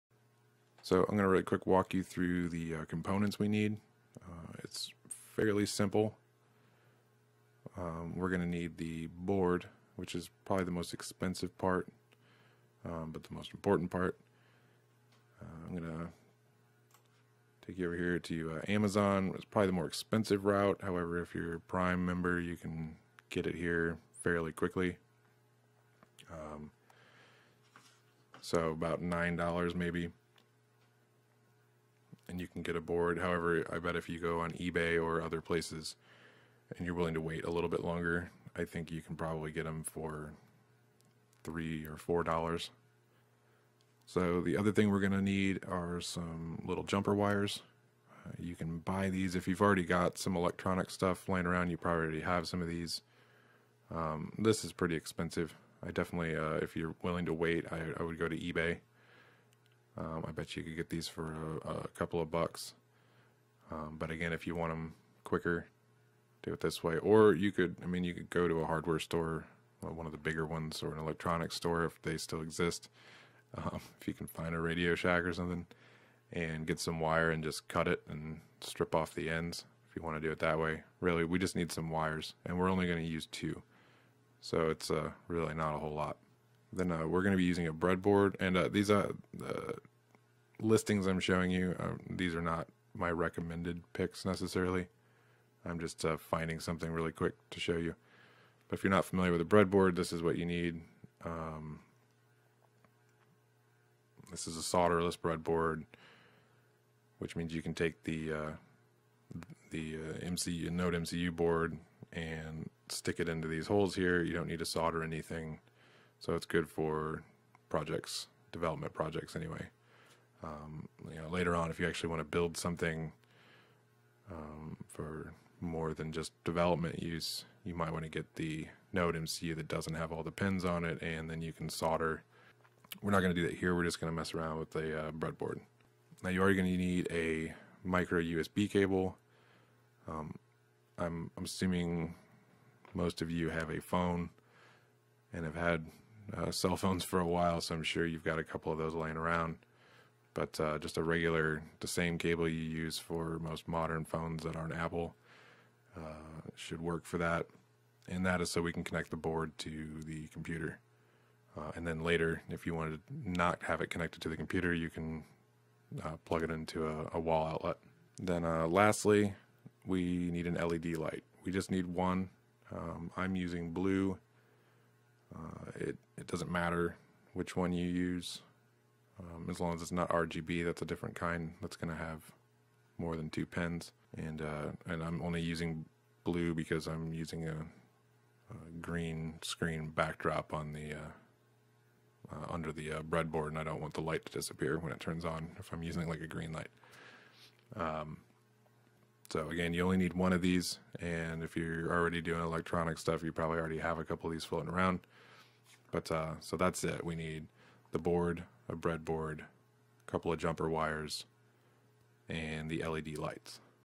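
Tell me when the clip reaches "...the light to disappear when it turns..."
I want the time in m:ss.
3:13.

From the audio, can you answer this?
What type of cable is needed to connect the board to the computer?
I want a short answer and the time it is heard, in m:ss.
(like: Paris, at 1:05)
micro USB cable, at 2:17.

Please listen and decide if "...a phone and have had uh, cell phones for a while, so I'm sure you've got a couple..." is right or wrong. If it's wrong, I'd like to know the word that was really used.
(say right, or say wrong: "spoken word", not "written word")
right.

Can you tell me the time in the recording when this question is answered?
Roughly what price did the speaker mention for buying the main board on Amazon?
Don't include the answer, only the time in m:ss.
0:29.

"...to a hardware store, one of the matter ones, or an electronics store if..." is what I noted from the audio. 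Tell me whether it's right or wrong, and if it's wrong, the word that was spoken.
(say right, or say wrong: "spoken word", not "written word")
wrong: "bigger", not "matter".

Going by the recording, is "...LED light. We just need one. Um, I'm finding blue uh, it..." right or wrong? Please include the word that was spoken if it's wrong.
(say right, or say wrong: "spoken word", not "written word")
wrong: "using", not "finding".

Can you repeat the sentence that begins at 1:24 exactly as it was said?
So it's uh, really not a whole lot then uh, we're going to be using a breadboard.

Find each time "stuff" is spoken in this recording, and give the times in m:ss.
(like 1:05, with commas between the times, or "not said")
0:50, 3:22.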